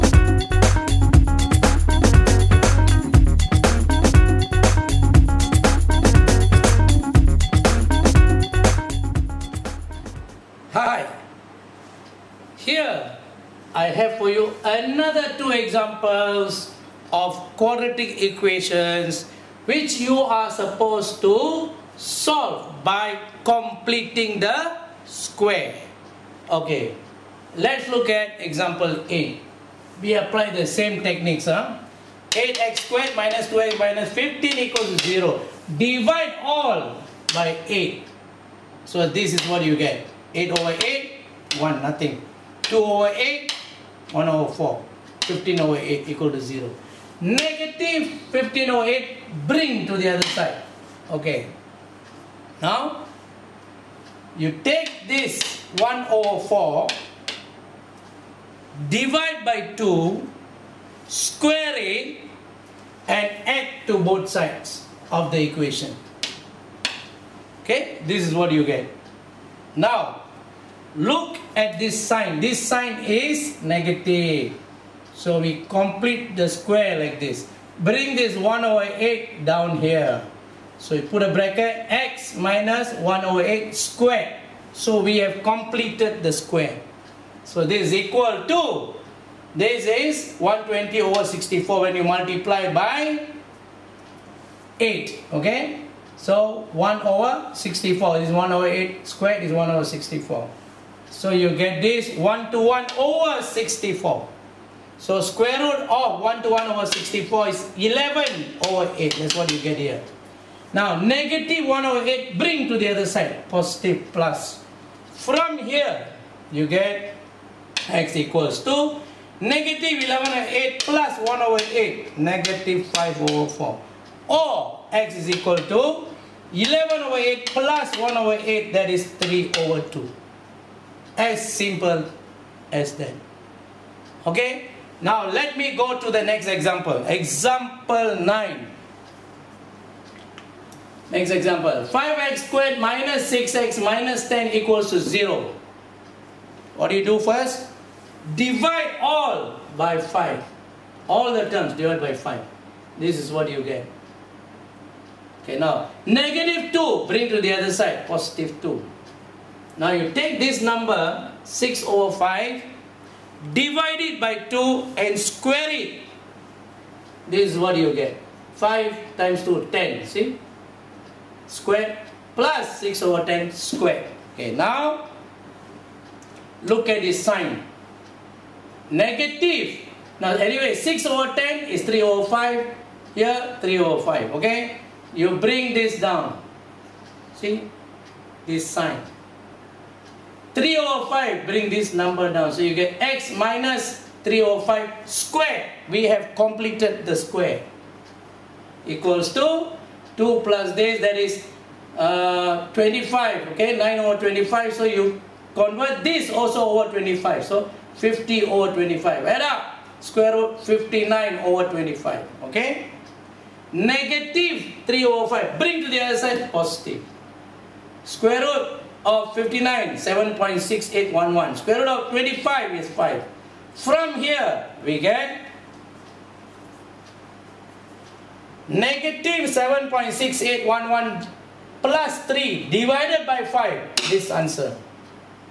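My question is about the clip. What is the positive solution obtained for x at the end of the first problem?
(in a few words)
3/2.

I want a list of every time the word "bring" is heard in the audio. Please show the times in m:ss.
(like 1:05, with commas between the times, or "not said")
0:49, 1:17, 1:52, 2:37, 3:05, 3:11, 3:35.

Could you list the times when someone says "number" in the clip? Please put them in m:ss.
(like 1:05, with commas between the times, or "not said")
2:40, 3:11.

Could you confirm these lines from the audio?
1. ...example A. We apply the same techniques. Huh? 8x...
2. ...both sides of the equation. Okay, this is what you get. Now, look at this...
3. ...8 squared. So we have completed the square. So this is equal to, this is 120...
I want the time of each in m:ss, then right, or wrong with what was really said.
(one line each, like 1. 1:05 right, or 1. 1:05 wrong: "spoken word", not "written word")
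1. 0:28 right
2. 1:03 right
3. 1:23 right.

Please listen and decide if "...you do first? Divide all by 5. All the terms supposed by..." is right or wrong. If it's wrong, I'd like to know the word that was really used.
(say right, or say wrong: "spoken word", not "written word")
wrong: "divided", not "supposed".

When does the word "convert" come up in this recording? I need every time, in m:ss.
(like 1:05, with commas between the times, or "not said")
3:25.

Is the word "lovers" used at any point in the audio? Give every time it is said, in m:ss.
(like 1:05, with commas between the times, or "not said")
not said.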